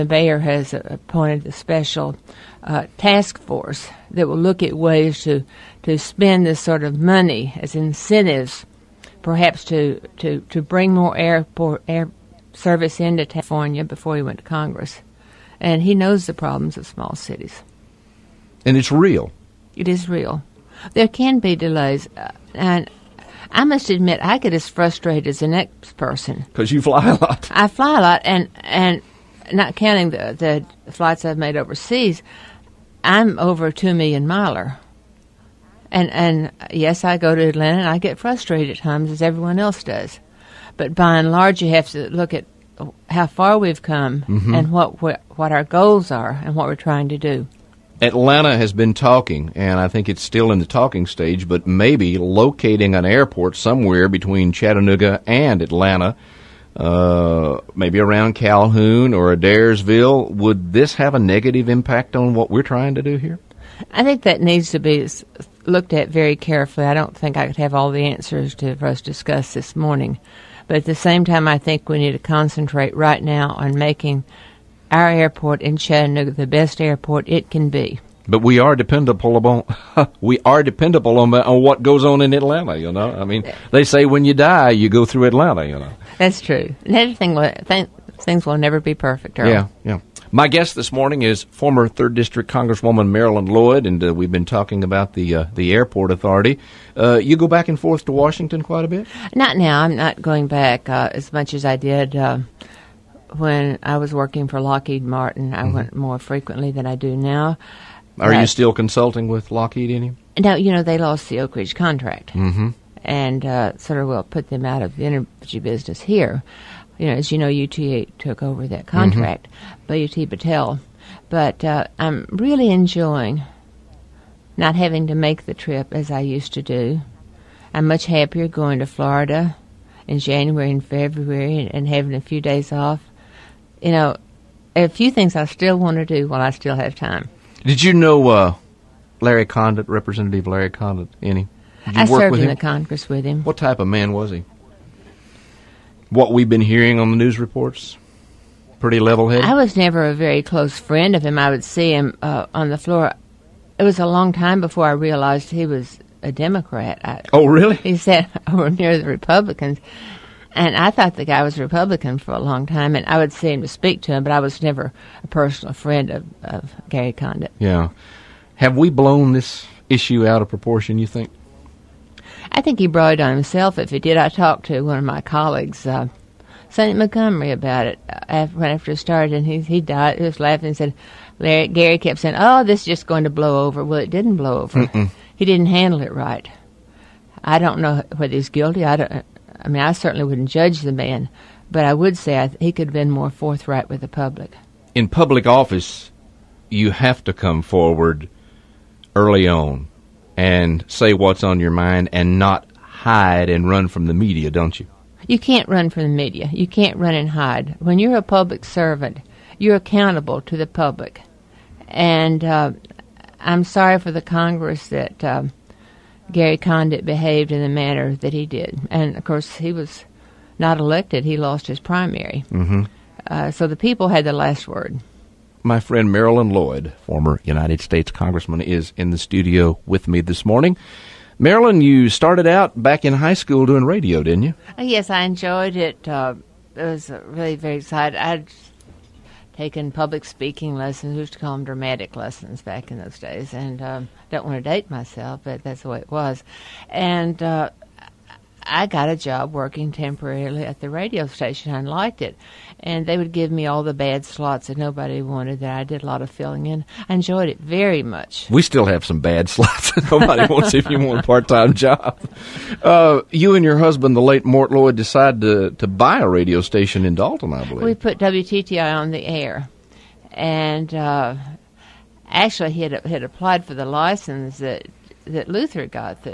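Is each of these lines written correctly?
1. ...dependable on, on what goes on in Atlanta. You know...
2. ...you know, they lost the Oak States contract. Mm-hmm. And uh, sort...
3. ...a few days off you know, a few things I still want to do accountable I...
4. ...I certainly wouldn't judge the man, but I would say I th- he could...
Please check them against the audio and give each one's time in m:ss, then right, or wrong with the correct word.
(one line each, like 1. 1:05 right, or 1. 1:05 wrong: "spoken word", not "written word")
1. 1:20 right
2. 1:50 wrong: "Ridge", not "States"
3. 2:12 wrong: "while", not "accountable"
4. 3:09 right.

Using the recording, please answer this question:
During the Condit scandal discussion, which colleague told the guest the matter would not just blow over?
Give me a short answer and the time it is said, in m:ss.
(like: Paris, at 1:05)
Sonny Montgomery, at 2:56.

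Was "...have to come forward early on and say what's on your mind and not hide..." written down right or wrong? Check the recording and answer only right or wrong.
right.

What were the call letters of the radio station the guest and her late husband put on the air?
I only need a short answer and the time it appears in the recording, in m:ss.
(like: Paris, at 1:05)
WTTI, at 4:28.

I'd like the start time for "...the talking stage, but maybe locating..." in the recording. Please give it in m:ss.
0:50.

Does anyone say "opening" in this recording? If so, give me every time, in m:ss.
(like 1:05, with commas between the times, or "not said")
not said.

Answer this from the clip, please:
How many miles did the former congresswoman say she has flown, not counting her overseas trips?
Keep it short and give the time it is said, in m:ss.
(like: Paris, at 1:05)
2 million, at 0:33.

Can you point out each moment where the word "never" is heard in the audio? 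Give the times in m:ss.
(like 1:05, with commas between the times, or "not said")
1:28, 2:29, 2:44.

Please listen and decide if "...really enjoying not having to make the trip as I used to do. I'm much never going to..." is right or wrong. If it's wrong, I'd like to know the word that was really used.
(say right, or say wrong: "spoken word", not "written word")
wrong: "happier", not "never".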